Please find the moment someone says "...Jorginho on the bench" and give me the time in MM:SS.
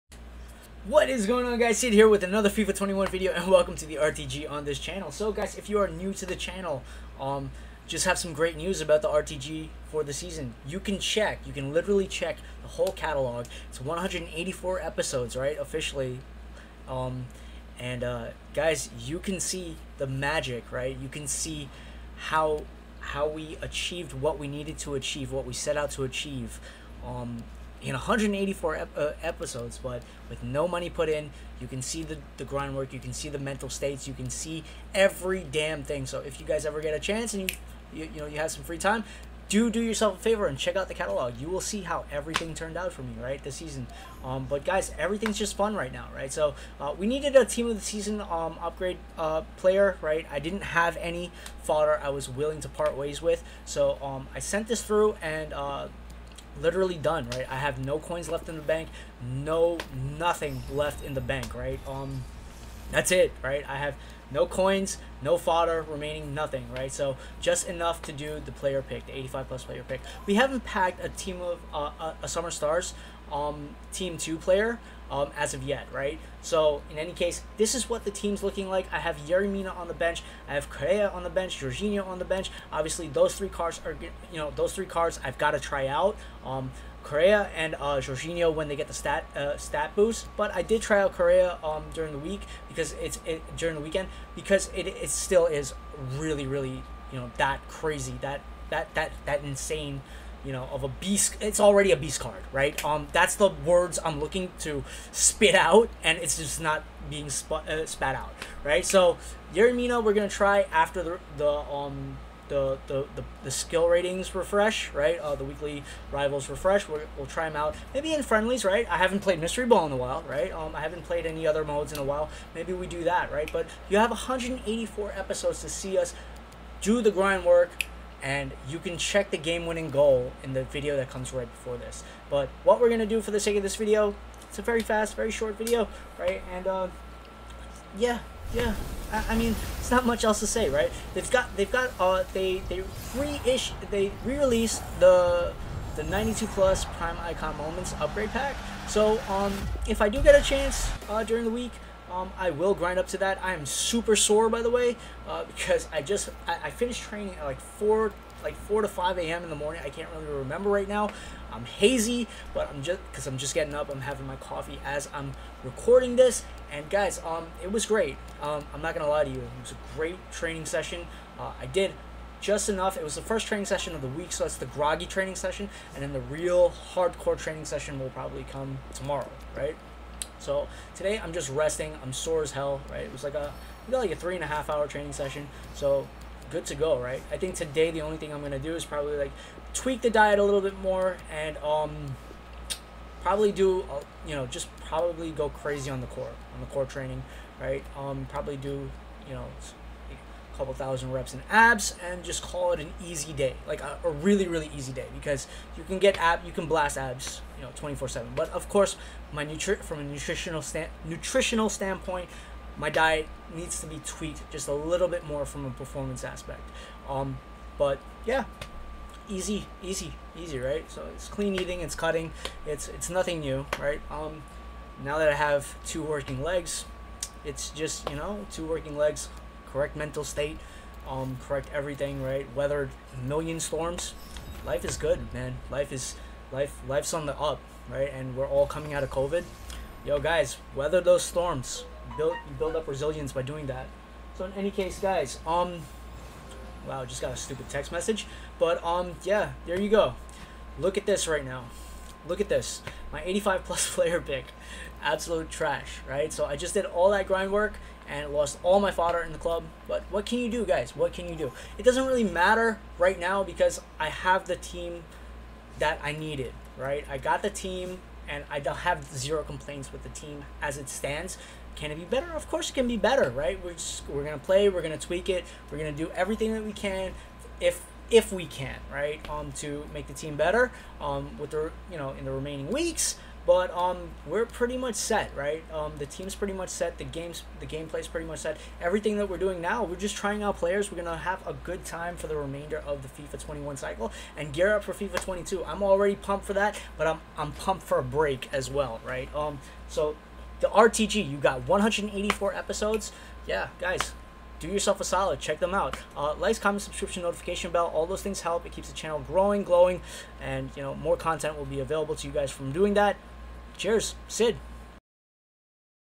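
01:21.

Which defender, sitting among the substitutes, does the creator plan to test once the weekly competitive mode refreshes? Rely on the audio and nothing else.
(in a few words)
Yerry Mina.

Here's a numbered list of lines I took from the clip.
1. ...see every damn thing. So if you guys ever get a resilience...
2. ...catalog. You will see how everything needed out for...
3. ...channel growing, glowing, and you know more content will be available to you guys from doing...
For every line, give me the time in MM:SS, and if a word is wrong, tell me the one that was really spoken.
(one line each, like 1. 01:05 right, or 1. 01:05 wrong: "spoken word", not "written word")
1. 00:34 wrong: "chance", not "resilience"
2. 00:40 wrong: "turned", not "needed"
3. 05:08 right.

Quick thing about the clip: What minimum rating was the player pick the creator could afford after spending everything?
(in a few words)
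85.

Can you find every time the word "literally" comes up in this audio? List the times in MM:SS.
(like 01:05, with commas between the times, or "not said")
00:11, 00:56.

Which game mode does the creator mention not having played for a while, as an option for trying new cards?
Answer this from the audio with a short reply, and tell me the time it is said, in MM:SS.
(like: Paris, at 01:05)
Mystery Ball, at 01:59.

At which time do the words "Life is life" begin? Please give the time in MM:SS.
03:55.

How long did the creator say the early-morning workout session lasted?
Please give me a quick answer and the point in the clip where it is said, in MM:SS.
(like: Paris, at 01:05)
3.5 hours, at 03:04.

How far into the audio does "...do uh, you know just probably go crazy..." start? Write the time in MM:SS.
03:13.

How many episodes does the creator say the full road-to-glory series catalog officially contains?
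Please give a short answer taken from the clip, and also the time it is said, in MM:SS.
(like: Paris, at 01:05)
184, at 00:13.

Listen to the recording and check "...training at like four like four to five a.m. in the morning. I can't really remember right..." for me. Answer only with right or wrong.
right.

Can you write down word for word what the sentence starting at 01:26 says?
Um, Correa and uh, Jorginho when they get the stat uh, stat boost.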